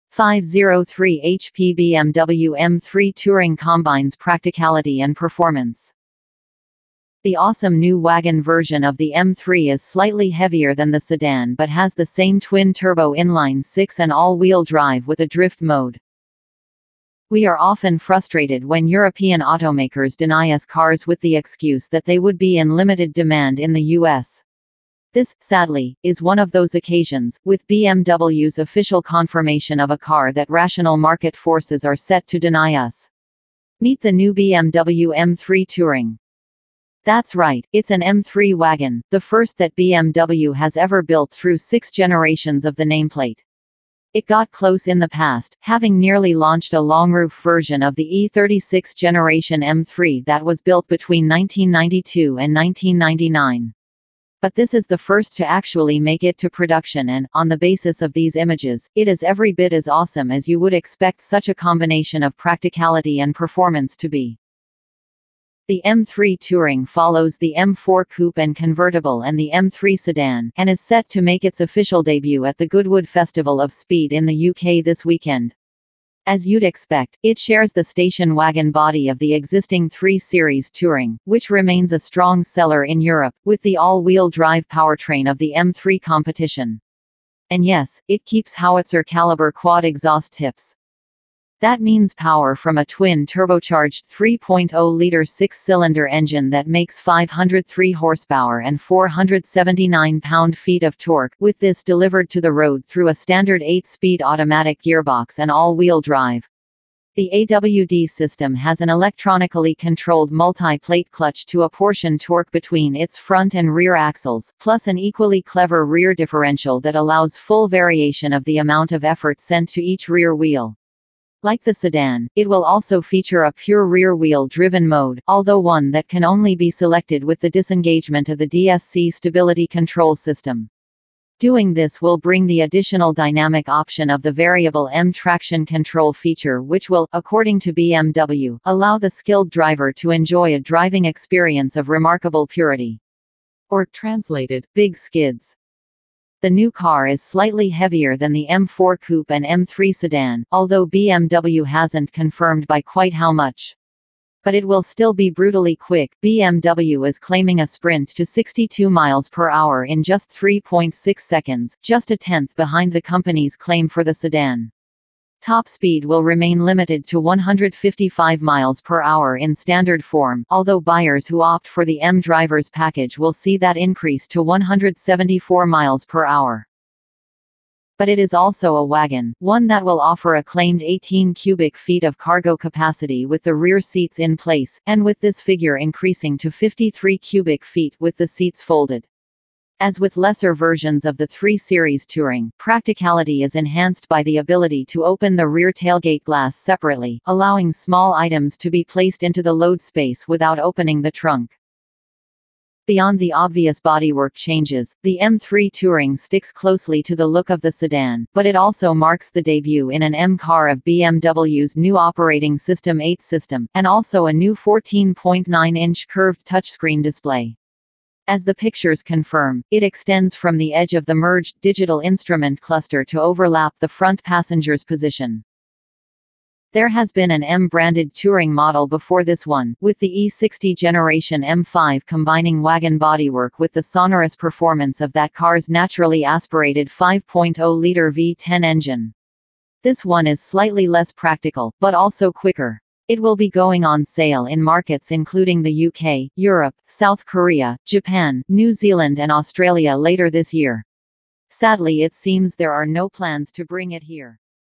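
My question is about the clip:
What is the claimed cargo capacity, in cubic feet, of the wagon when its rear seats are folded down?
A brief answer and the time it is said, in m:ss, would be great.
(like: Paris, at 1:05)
53 cubic feet, at 3:06.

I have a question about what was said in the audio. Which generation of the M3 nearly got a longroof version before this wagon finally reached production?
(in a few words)
E36.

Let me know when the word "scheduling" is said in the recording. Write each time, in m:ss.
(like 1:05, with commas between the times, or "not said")
not said.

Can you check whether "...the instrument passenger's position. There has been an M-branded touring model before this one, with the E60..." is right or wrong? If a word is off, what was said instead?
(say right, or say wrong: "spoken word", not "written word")
wrong: "front", not "instrument".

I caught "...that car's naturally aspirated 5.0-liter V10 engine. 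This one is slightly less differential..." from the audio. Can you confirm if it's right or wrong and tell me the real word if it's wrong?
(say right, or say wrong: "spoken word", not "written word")
wrong: "practical", not "differential".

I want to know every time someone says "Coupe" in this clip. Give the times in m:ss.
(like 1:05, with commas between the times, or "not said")
1:08, 2:28.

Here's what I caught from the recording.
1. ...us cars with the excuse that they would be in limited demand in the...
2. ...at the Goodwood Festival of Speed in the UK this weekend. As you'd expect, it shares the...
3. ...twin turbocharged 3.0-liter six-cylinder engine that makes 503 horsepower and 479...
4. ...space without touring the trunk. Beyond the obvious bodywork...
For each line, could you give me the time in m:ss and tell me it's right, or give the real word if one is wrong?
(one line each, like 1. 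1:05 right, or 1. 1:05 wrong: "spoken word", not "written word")
1. 0:20 right
2. 1:12 right
3. 1:32 right
4. 3:19 wrong: "opening", not "touring".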